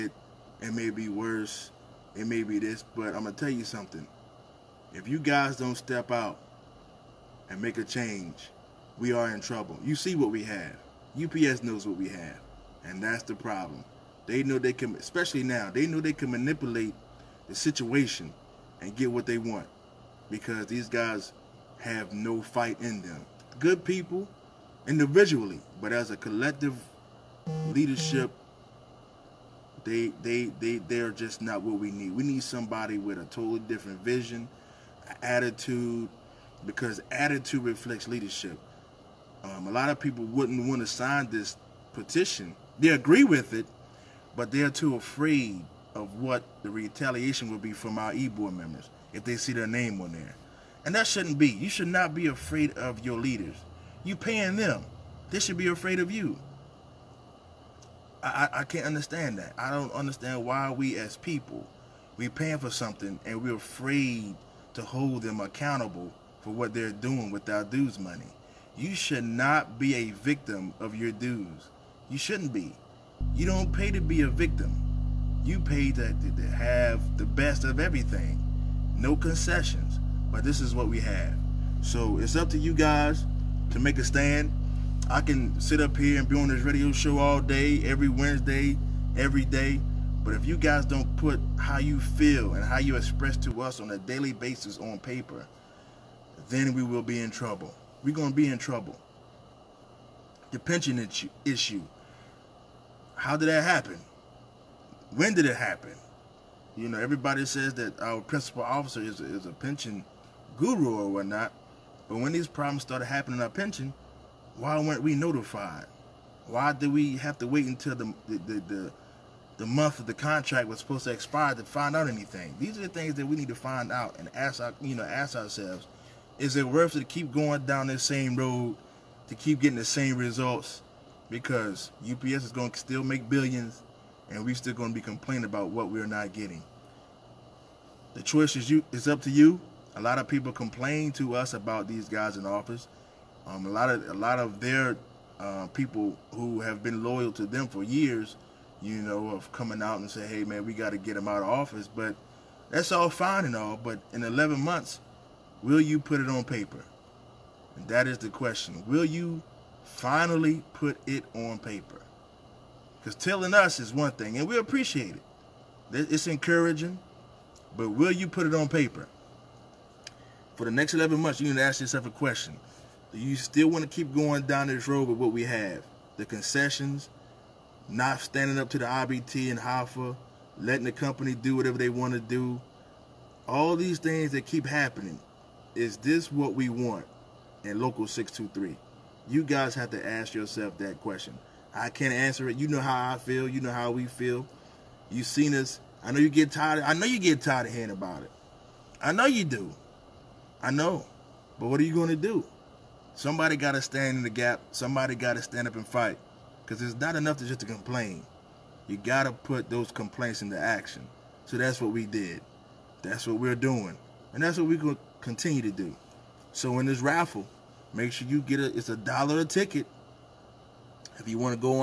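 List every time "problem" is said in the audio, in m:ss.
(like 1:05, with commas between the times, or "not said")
0:13, 1:52.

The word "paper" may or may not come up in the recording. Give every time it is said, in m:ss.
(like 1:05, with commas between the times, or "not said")
1:34, 2:36, 2:41, 2:48.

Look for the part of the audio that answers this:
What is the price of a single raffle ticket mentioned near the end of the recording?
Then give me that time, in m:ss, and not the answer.
3:38.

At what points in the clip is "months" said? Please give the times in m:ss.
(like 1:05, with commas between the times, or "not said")
1:59, 2:34, 2:51.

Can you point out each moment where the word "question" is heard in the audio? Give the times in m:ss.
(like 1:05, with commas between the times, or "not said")
2:38, 2:52, 3:11.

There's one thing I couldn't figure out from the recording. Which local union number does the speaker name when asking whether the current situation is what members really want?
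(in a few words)
Local 623.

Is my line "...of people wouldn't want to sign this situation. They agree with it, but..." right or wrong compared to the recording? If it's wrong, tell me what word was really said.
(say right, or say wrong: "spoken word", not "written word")
wrong: "petition", not "situation".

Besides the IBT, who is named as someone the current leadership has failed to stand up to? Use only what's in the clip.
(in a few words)
Hoffa.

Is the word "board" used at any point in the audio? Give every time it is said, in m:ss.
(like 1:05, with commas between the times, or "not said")
0:48.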